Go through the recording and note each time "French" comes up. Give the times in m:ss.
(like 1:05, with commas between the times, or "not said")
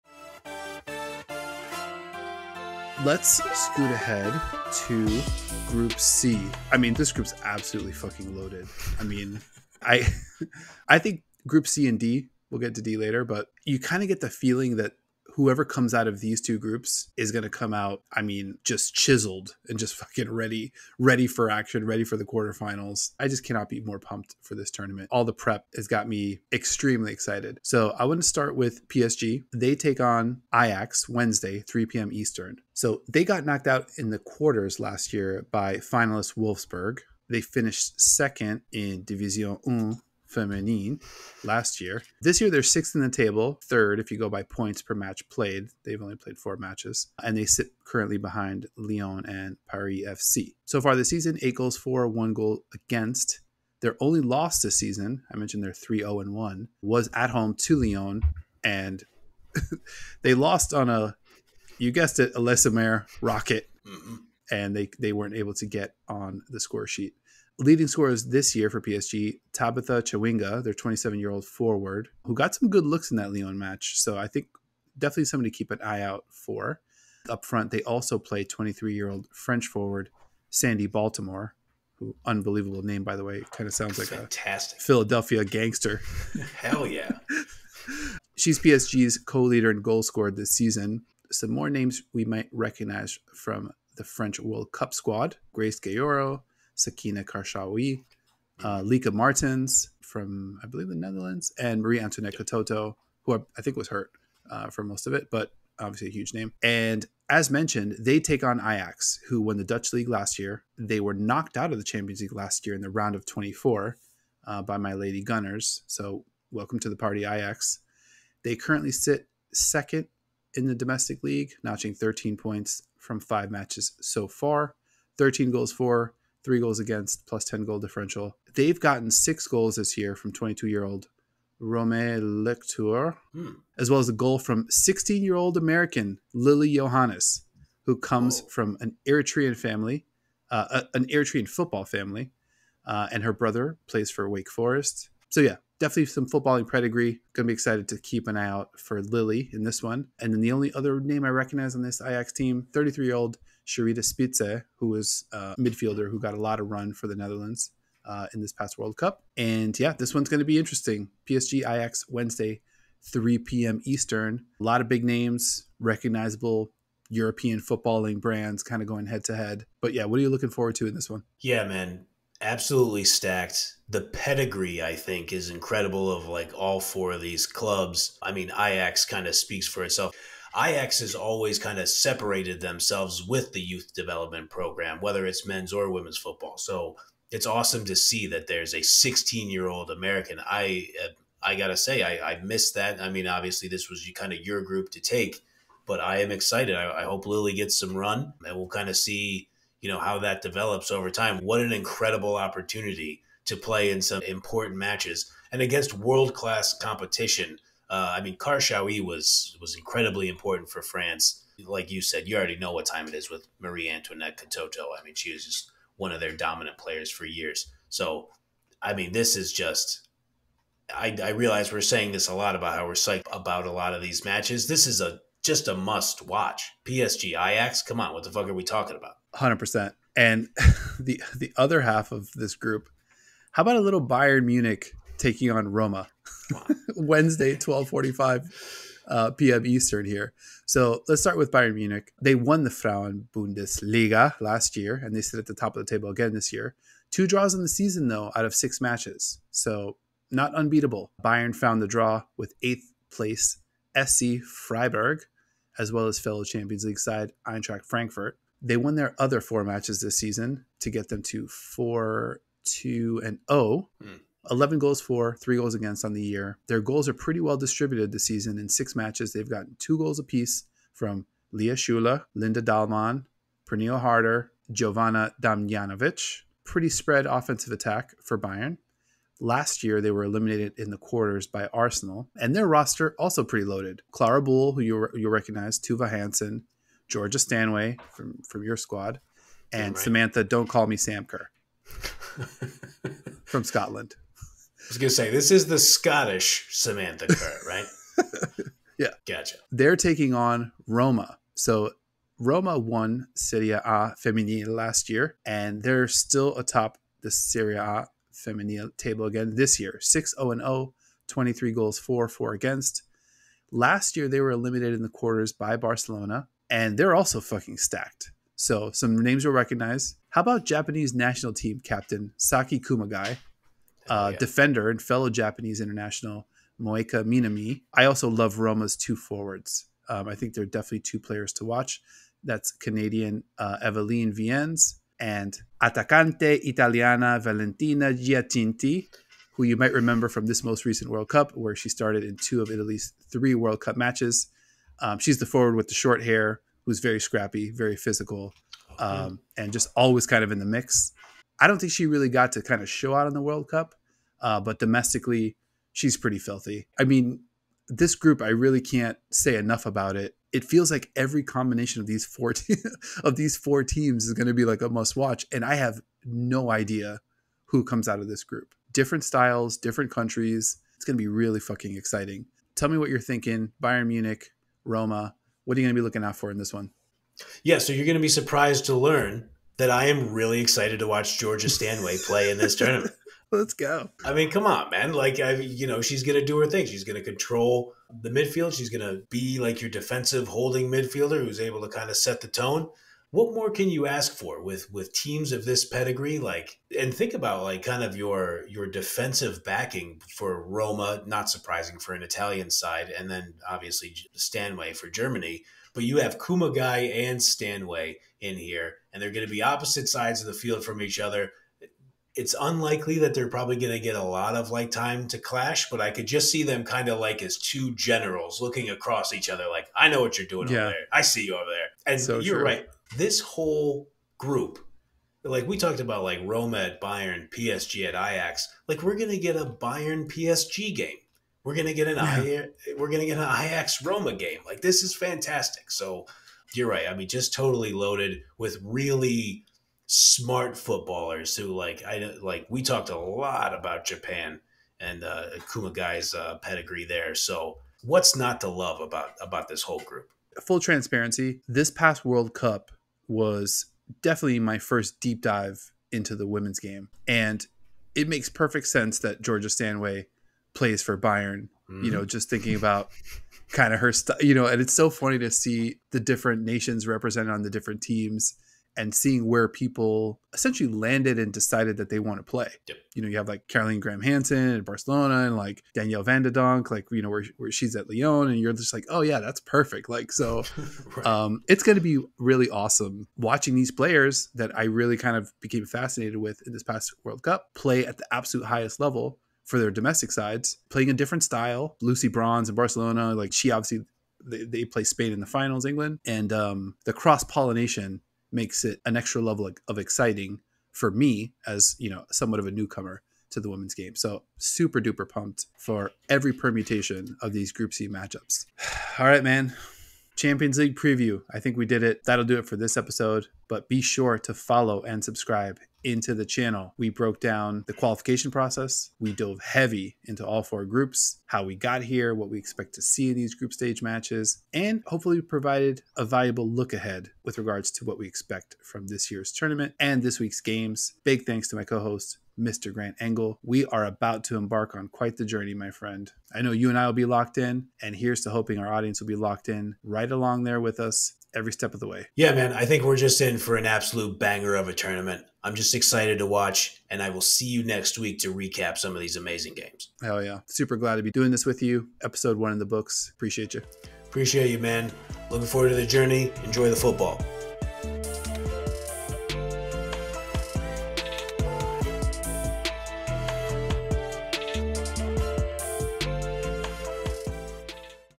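1:19, 1:34.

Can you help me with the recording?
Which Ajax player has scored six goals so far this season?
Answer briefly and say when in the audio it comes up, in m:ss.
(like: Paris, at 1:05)
Romée Leuchter, at 2:11.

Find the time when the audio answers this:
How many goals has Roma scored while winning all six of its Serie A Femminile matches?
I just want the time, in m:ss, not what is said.
5:11.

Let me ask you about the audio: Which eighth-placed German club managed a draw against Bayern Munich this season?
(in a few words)
SC Freiburg.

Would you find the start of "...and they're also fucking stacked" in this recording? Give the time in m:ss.
5:16.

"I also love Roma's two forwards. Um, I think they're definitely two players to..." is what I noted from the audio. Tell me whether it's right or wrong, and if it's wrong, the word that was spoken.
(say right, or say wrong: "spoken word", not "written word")
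right.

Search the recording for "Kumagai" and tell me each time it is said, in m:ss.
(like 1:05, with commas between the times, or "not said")
5:22, 6:46.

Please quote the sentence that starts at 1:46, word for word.
And as mentioned, they take on Ajax, who won the Dutch league last year.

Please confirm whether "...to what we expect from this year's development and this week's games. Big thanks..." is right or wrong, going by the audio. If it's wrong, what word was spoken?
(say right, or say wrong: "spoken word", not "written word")
wrong: "tournament", not "development".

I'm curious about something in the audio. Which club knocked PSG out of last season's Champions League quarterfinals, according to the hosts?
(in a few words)
Wolfsburg.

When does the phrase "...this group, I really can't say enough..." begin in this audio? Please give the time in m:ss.
5:57.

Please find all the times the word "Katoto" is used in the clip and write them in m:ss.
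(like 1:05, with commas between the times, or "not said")
1:42, 3:34.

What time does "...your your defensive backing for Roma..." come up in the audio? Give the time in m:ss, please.
6:38.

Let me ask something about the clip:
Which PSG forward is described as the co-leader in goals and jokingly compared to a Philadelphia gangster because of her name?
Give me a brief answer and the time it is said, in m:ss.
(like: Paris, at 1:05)
Sandy Baltimore, at 1:20.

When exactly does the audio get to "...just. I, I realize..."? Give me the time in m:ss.
3:39.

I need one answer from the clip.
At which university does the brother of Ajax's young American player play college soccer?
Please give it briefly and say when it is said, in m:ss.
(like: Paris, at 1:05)
Wake Forest, at 2:24.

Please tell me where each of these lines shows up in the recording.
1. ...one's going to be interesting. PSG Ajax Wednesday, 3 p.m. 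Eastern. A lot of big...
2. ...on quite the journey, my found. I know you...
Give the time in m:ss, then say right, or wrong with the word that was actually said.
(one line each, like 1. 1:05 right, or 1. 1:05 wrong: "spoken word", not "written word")
1. 2:40 right
2. 8:54 wrong: "friend", not "found".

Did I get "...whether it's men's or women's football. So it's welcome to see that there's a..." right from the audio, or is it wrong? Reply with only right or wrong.
wrong.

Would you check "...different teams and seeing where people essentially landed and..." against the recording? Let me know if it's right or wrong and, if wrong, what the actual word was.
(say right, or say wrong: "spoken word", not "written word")
right.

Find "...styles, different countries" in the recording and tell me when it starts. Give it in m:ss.
6:09.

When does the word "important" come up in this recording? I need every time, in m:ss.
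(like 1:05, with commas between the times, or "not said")
3:24, 3:30.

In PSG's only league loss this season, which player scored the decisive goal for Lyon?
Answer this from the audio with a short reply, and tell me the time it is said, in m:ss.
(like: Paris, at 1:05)
Le Sommer, at 1:02.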